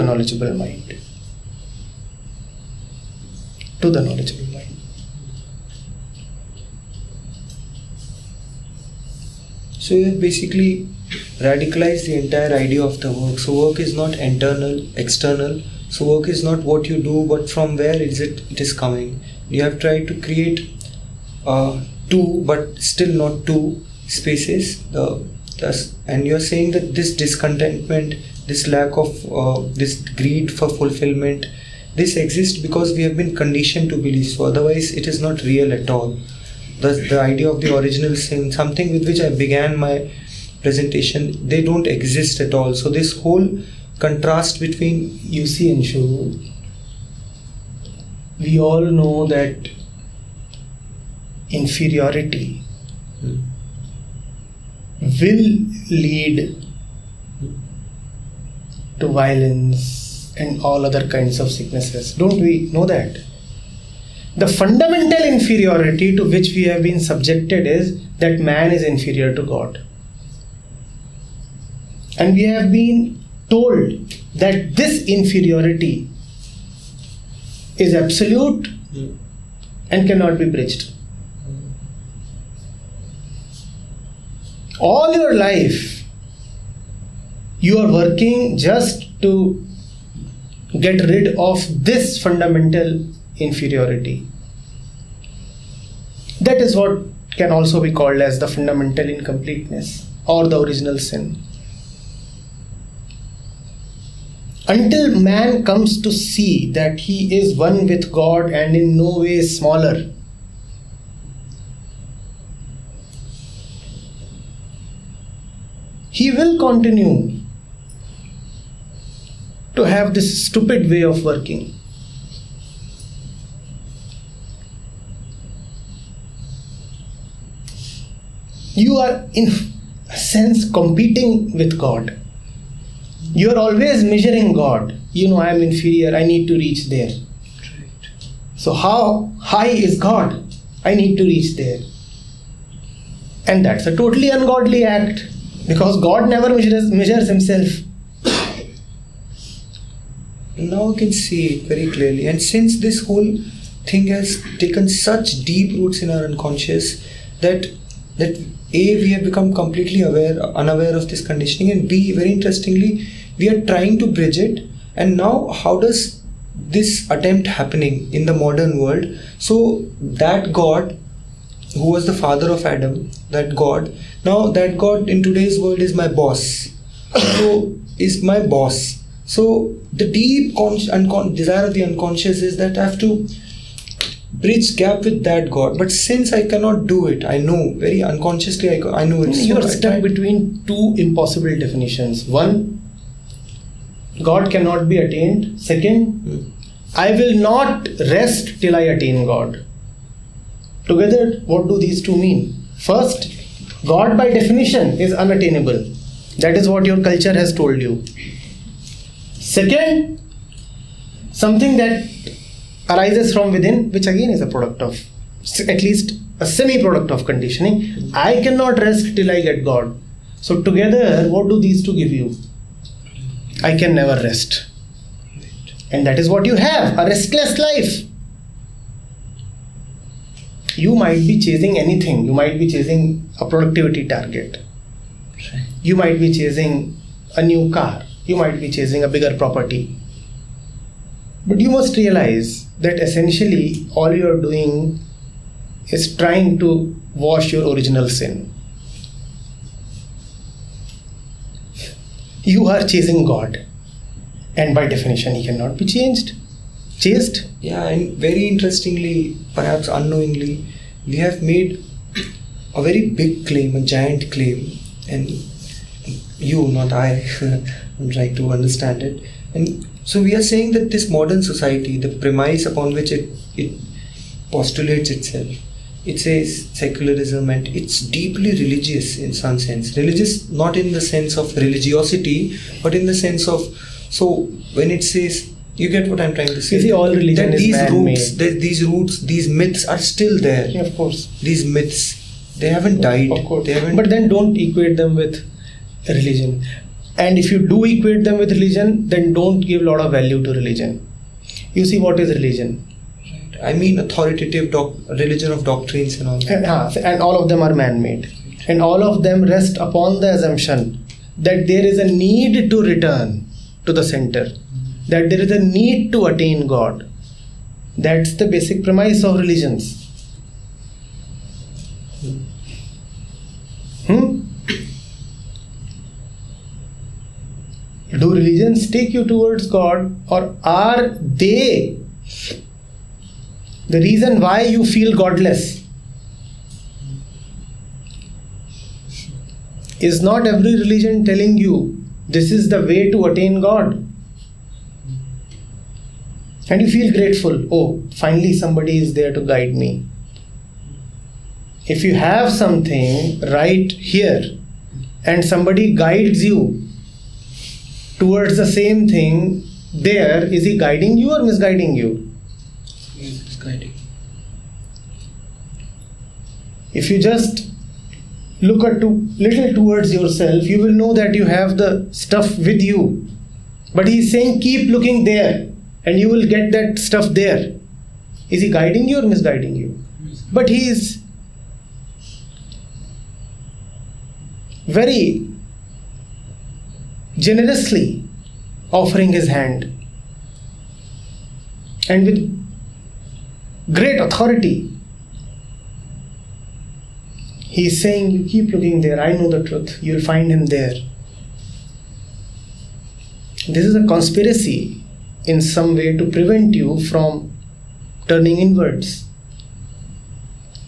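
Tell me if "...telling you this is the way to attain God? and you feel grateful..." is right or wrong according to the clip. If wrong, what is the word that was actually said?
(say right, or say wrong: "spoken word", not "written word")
right.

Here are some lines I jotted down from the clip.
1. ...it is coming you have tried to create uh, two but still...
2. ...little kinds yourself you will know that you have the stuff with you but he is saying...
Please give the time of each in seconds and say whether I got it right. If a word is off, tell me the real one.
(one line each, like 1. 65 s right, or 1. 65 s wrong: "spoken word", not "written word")
1. 18 s right
2. 369 s wrong: "towards", not "kinds".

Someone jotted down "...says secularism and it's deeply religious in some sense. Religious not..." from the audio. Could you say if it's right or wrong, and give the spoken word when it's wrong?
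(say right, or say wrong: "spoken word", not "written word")
right.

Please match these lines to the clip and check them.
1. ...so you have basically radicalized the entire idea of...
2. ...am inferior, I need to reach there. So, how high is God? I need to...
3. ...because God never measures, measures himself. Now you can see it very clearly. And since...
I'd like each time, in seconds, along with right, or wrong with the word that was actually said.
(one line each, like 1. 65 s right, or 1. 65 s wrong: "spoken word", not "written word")
1. 9 s right
2. 135 s right
3. 145 s right.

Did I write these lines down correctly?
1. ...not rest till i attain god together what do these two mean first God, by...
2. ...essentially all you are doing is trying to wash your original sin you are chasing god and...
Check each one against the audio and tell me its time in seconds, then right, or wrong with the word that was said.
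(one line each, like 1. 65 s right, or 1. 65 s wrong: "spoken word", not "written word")
1. 197 s right
2. 242 s right.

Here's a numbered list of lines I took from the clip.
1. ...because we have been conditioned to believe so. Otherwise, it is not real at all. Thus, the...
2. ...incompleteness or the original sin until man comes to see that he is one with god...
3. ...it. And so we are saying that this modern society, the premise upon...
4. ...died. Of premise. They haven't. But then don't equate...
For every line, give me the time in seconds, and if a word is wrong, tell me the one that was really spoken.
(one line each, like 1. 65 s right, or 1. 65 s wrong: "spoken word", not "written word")
1. 32 s right
2. 99 s right
3. 269 s right
4. 292 s wrong: "course", not "premise".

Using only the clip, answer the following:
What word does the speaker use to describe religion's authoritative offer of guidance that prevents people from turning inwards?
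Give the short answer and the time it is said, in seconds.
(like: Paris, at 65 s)
conspiracy, at 404 s.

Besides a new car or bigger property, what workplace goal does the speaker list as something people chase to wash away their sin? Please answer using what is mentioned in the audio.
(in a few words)
a productivity target.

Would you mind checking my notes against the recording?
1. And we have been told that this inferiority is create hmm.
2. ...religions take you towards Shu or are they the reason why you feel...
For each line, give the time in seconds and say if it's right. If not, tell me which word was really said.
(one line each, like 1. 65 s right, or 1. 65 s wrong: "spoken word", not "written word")
1. 72 s wrong: "absolute", not "create"
2. 328 s wrong: "God", not "Shu".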